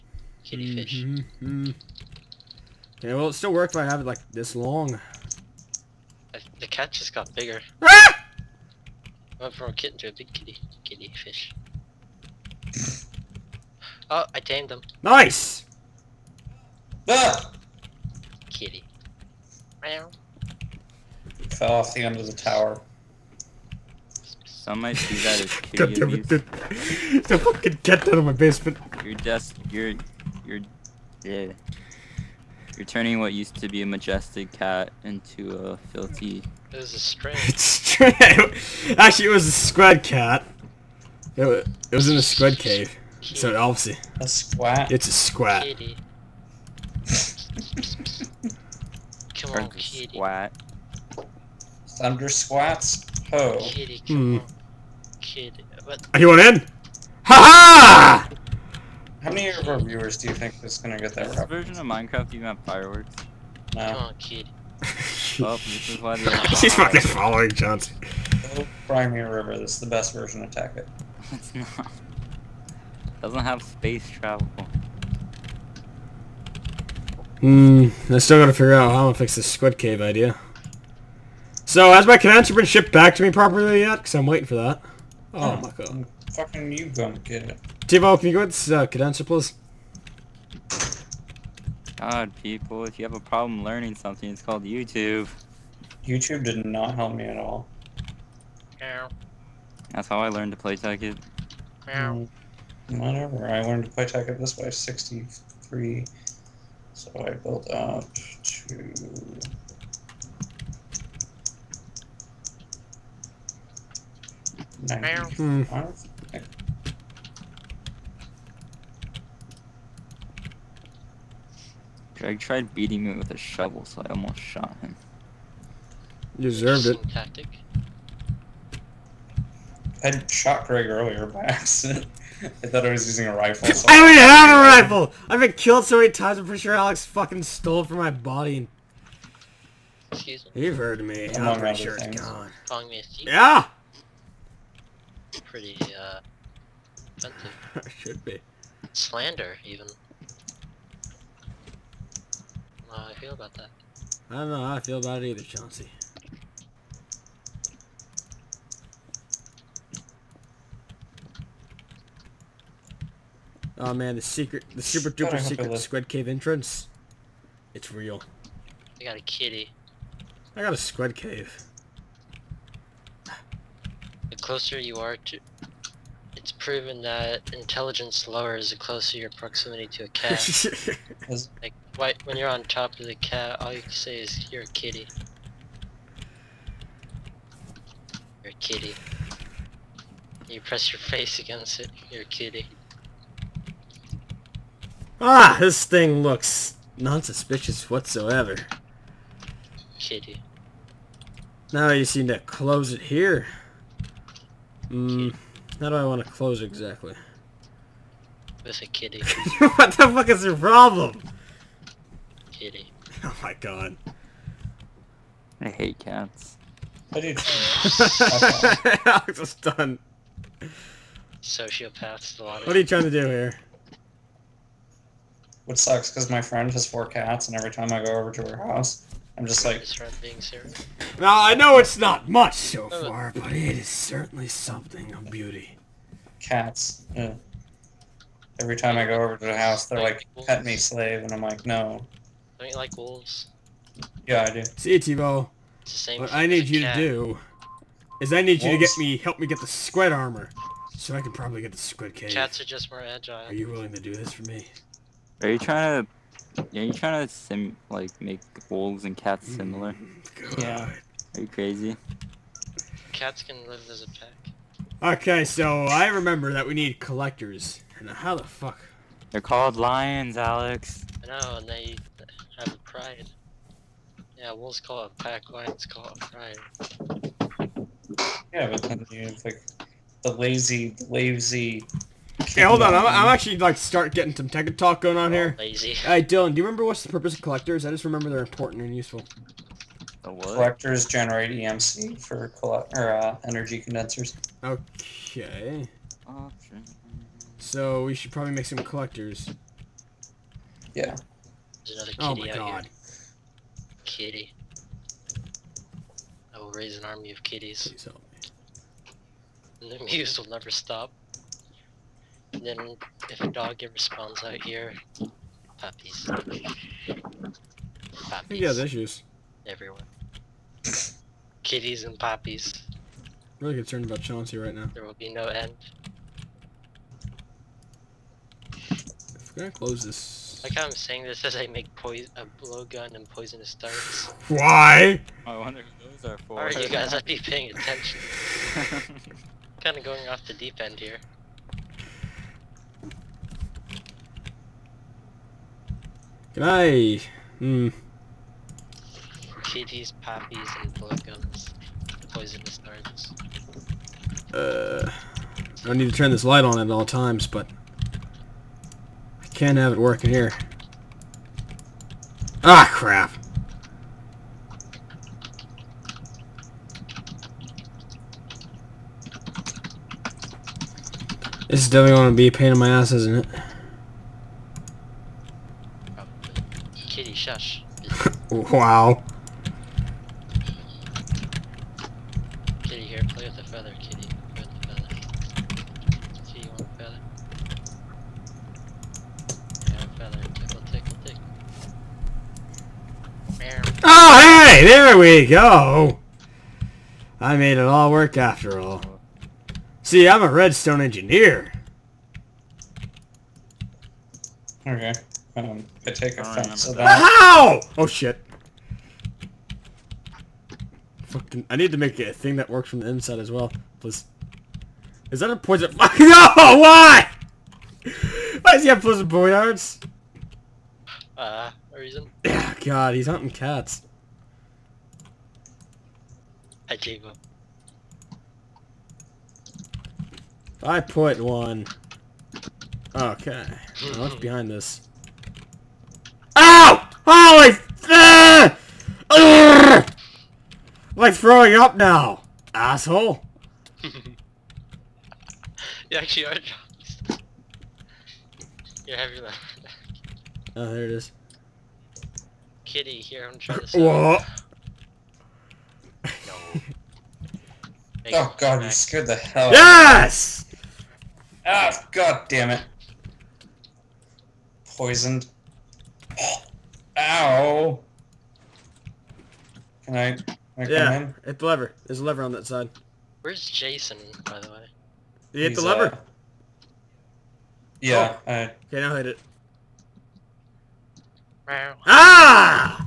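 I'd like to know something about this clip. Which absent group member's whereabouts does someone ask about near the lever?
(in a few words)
Jason.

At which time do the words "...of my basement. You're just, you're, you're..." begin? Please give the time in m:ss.
0:28.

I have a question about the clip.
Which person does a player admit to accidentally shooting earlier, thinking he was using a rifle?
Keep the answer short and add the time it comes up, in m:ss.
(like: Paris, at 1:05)
Greg, at 2:10.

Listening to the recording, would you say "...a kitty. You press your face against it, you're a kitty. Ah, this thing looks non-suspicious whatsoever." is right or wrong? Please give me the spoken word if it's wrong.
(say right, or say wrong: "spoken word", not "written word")
right.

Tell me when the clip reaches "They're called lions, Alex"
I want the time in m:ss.
4:29.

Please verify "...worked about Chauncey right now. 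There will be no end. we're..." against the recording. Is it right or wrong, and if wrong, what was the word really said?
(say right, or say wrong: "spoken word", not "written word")
wrong: "concerned", not "worked".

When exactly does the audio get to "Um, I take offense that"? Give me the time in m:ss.
6:45.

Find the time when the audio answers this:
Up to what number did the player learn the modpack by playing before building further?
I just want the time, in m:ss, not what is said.
1:44.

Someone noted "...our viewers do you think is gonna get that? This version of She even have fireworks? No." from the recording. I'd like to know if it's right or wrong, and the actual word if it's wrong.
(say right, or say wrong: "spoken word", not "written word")
wrong: "Minecraft", not "She".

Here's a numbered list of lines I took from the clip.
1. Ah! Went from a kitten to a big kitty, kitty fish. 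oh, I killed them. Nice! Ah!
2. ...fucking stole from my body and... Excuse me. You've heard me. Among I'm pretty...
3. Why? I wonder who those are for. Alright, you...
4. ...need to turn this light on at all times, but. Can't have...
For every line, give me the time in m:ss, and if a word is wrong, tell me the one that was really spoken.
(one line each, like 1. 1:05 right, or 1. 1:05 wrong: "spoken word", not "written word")
1. 0:07 wrong: "tamed", not "killed"
2. 2:17 right
3. 5:34 right
4. 5:55 right.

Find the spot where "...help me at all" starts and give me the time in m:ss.
1:36.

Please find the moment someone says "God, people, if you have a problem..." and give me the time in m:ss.
1:32.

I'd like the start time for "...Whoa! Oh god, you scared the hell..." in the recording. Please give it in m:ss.
7:33.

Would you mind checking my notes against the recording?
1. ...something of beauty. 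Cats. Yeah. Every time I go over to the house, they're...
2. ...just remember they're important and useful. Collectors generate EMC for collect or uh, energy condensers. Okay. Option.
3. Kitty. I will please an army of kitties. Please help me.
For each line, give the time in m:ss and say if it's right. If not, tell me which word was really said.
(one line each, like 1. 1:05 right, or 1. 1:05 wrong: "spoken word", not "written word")
1. 3:54 right
2. 4:47 right
3. 5:04 wrong: "raise", not "please".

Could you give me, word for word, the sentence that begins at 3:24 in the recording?
Hmm, how do I want to close exactly?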